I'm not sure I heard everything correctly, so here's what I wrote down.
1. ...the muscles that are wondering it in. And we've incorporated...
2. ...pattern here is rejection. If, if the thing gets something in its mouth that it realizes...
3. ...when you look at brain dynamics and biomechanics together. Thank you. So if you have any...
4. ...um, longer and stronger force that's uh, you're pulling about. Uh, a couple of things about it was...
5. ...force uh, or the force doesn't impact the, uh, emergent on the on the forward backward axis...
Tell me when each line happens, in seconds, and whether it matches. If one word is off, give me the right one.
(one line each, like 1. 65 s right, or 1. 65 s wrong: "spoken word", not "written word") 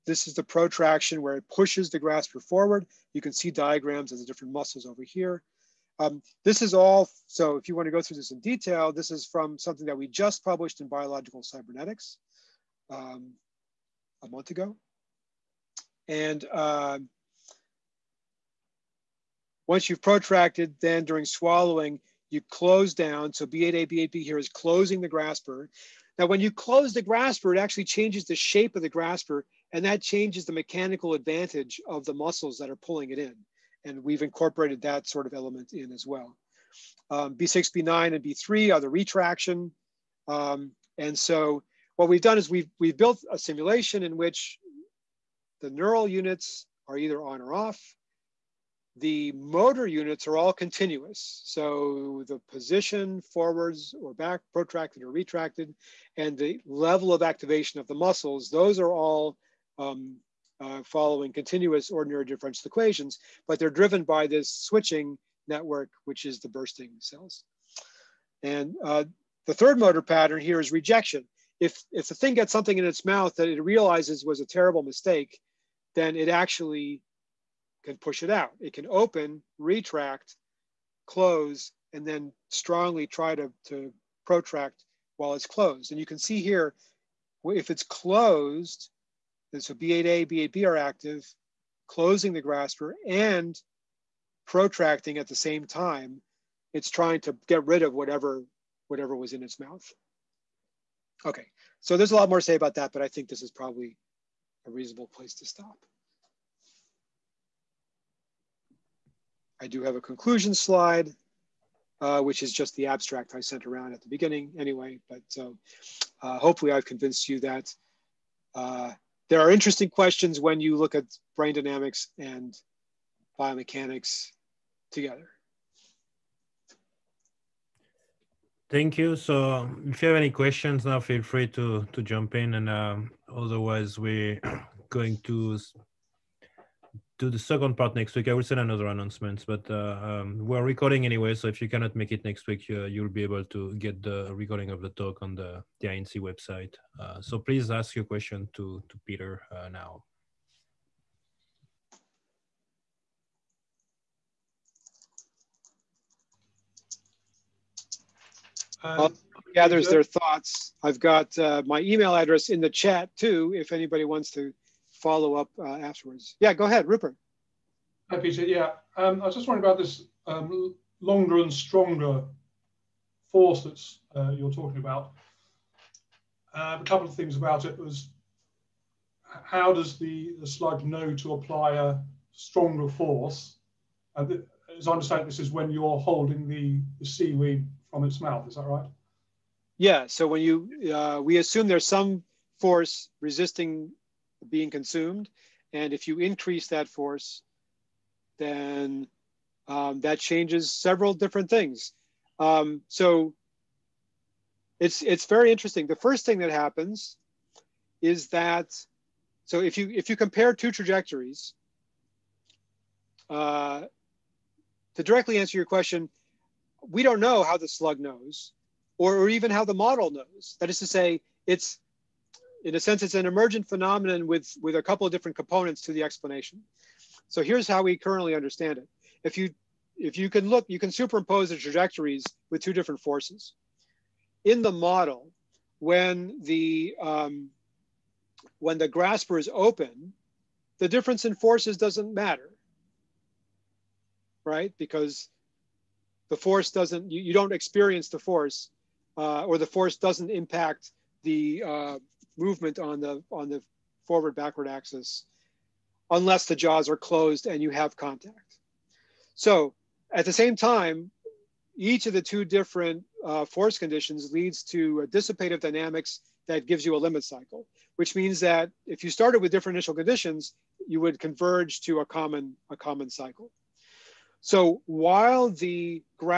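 1. 32 s wrong: "pulling", not "wondering"
2. 70 s right
3. 120 s right
4. 170 s wrong: "talking", not "pulling"
5. 248 s wrong: "movement", not "emergent".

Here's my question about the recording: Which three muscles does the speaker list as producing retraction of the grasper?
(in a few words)
B6, B9, and B3.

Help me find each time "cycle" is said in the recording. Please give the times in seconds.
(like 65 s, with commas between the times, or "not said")
267 s, 273 s.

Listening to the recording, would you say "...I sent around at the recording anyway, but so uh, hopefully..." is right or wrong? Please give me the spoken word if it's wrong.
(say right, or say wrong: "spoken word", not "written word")
wrong: "beginning", not "recording".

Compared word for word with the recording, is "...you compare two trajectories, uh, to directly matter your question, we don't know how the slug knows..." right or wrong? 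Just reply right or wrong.
wrong.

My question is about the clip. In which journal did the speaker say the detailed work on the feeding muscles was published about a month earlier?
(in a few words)
Biological Cybernetics.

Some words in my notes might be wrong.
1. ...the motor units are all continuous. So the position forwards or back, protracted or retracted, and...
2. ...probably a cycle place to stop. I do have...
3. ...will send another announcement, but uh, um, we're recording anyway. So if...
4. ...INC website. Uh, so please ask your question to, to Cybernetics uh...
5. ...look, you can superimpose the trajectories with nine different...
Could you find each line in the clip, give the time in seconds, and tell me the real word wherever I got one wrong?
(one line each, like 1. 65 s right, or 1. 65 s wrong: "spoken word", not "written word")
1. 48 s right
2. 103 s wrong: "reasonable", not "cycle"
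3. 138 s right
4. 145 s wrong: "Peter", not "Cybernetics"
5. 230 s wrong: "two", not "nine".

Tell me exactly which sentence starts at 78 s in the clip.
It can open, retract, close, and then strongly try to, to protract while it's closed.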